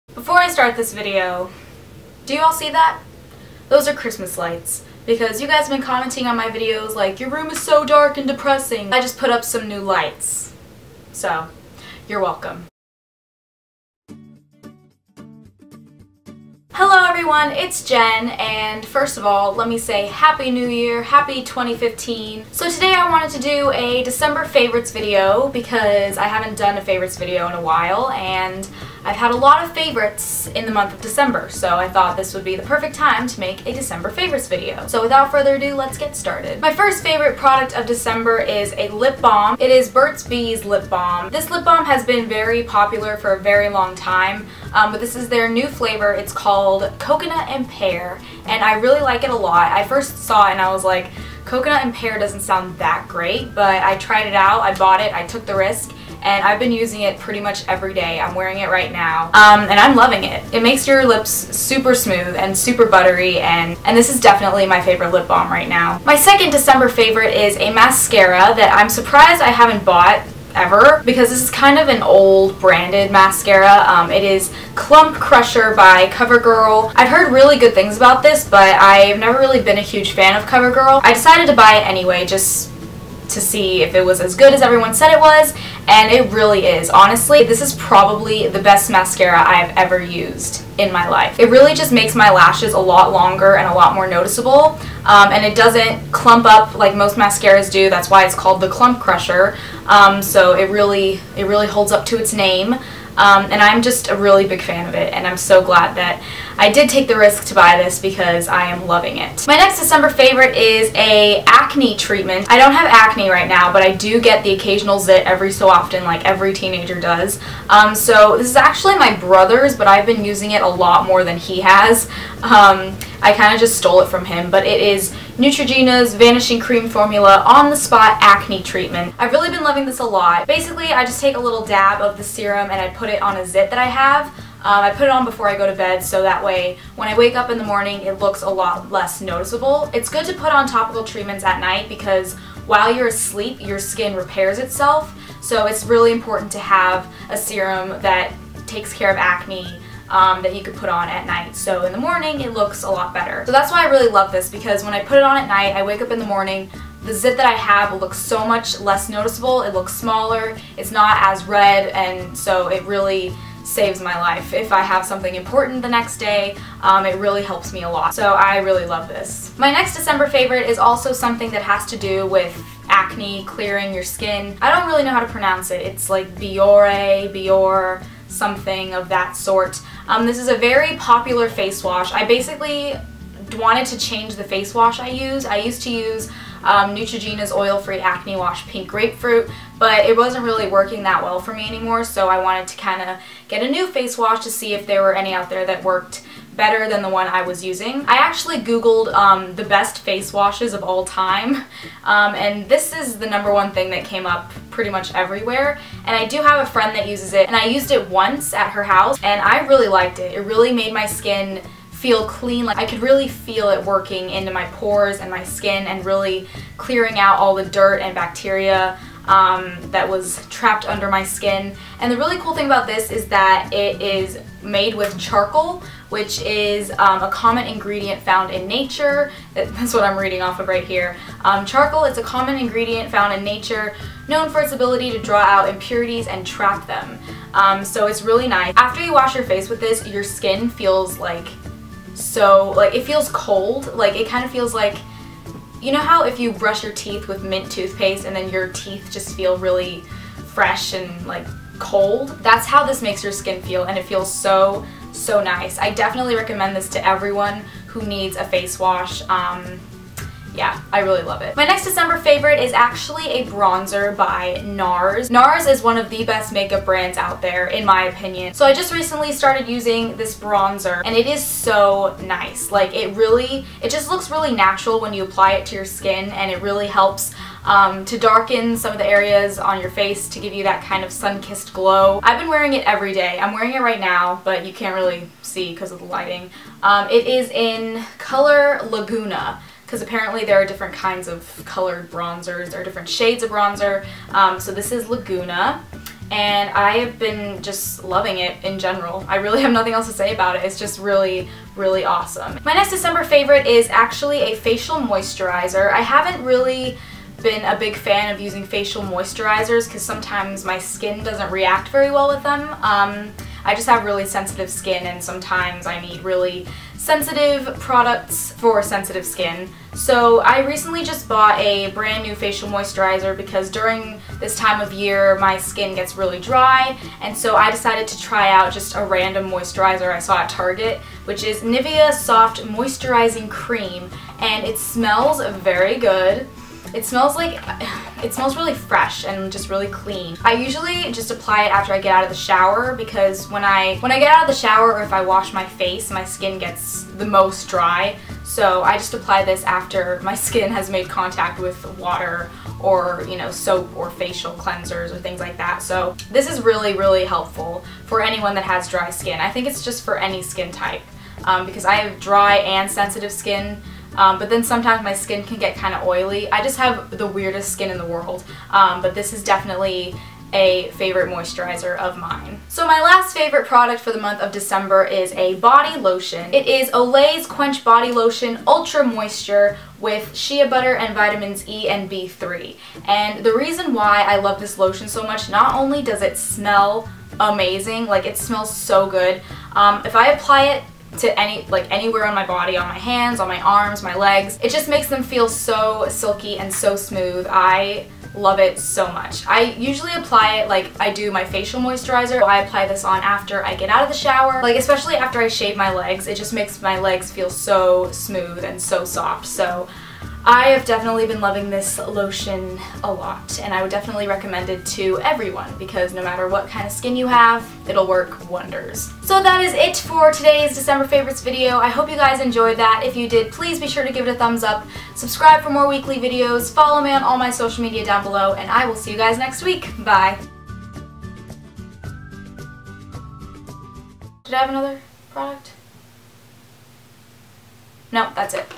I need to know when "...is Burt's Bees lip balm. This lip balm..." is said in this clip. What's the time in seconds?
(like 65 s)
39 s.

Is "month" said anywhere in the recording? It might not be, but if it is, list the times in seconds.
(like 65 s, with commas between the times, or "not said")
30 s, 374 s.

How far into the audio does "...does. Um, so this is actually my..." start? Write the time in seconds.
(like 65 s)
117 s.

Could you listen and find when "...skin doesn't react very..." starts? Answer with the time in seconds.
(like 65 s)
310 s.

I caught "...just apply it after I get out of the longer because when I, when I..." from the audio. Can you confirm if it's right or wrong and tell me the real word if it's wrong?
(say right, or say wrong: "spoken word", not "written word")
wrong: "shower", not "longer".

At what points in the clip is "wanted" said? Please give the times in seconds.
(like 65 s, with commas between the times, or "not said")
23 s, 183 s, 192 s.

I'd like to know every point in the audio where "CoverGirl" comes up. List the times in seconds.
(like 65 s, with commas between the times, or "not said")
76 s, 80 s.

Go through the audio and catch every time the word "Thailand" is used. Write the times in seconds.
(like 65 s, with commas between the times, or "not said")
not said.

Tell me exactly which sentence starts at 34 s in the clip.
So without further ado, let's get started.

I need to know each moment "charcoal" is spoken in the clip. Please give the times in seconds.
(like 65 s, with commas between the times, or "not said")
225 s, 231 s.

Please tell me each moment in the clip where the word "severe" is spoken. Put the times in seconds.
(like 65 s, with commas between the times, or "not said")
not said.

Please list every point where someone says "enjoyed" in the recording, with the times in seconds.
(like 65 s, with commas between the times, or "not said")
422 s.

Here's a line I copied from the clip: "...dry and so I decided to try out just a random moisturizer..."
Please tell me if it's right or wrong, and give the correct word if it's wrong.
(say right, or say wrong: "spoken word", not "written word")
right.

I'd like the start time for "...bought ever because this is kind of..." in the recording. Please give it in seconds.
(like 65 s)
69 s.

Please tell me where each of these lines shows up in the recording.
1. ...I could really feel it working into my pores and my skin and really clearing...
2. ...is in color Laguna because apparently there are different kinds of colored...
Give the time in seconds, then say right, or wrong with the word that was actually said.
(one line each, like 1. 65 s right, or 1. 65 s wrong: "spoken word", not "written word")
1. 212 s right
2. 287 s right.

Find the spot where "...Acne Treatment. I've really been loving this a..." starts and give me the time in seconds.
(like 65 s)
128 s.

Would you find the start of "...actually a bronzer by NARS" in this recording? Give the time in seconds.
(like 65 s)
262 s.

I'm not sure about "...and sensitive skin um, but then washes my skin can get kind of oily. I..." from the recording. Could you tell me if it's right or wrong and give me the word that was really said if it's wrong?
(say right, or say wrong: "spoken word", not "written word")
wrong: "sometimes", not "washes".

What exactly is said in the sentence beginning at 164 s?
If I have something important the next day, um, it really helps me a lot.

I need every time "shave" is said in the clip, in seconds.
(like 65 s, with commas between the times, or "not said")
405 s.